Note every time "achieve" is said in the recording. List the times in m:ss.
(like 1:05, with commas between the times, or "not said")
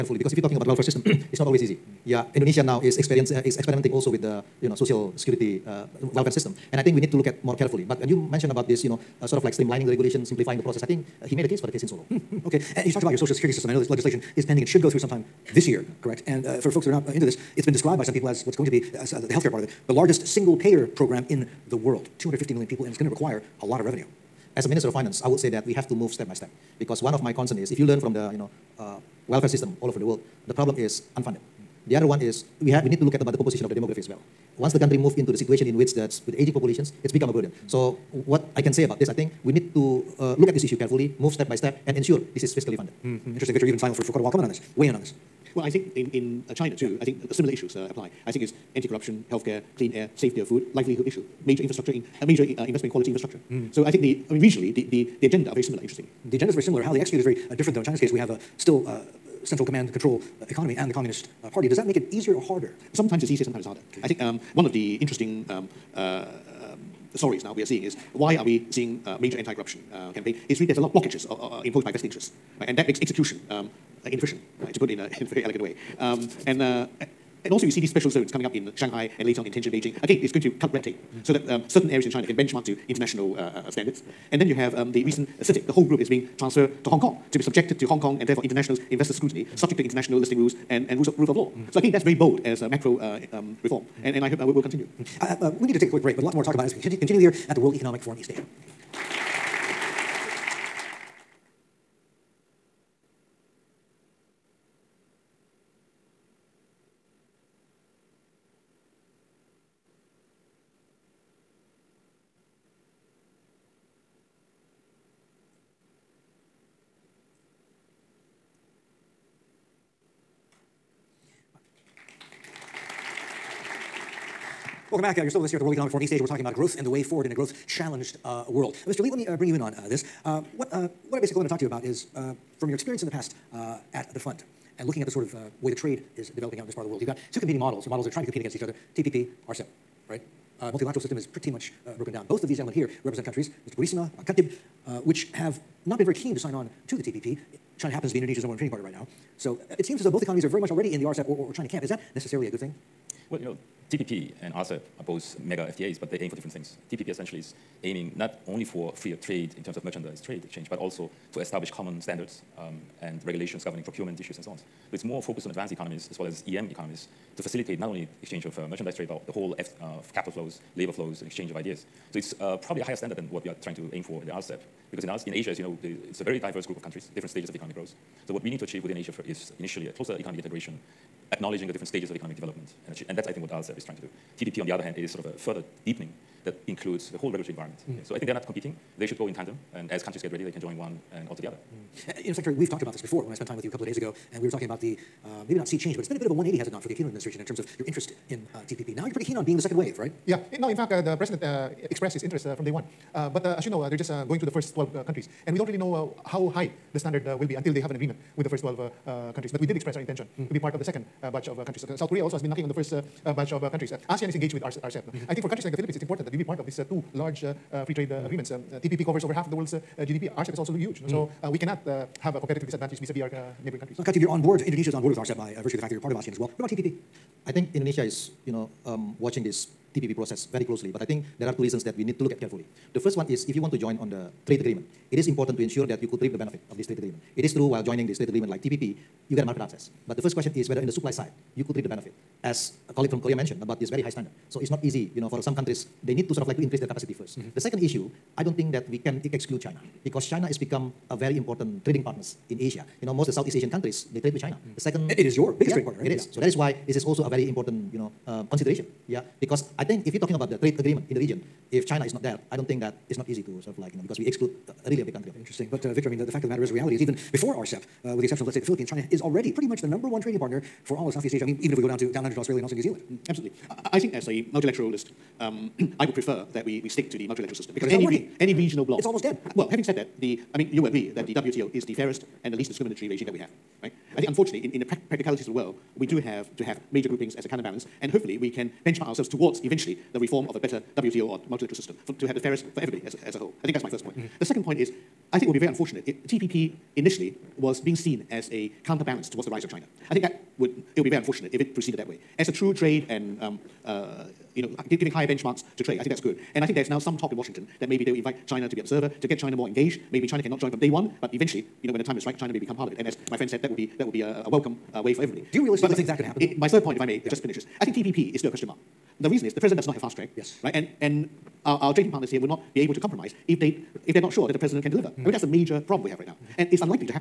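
2:58, 3:02.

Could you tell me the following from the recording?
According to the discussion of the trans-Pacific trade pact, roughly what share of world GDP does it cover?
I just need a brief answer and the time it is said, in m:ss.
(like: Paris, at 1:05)
over half, at 3:39.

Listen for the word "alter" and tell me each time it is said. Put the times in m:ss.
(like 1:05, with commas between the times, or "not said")
3:11.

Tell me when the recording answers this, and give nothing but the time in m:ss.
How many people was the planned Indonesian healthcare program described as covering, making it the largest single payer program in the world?
0:22.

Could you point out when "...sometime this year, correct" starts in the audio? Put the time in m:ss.
0:14.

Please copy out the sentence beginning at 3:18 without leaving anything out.
Now you're pretty keen on being the second wave, right?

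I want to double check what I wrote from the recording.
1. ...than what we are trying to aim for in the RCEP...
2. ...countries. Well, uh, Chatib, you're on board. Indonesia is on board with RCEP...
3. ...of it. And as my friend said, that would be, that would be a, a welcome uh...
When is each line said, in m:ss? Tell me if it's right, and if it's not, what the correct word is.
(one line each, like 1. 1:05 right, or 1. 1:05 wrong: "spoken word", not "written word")
1. 2:53 right
2. 3:43 right
3. 5:12 right.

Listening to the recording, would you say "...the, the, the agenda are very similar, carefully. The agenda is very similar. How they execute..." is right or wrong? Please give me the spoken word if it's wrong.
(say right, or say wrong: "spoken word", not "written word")
wrong: "interestingly", not "carefully".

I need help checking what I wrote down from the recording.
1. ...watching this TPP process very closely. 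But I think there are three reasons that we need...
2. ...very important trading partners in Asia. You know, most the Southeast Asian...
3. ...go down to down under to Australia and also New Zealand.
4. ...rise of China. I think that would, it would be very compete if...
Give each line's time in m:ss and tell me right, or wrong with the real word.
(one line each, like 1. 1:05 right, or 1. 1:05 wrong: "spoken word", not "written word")
1. 3:49 wrong: "two", not "three"
2. 4:11 right
3. 4:31 right
4. 4:59 wrong: "unfortunate", not "compete".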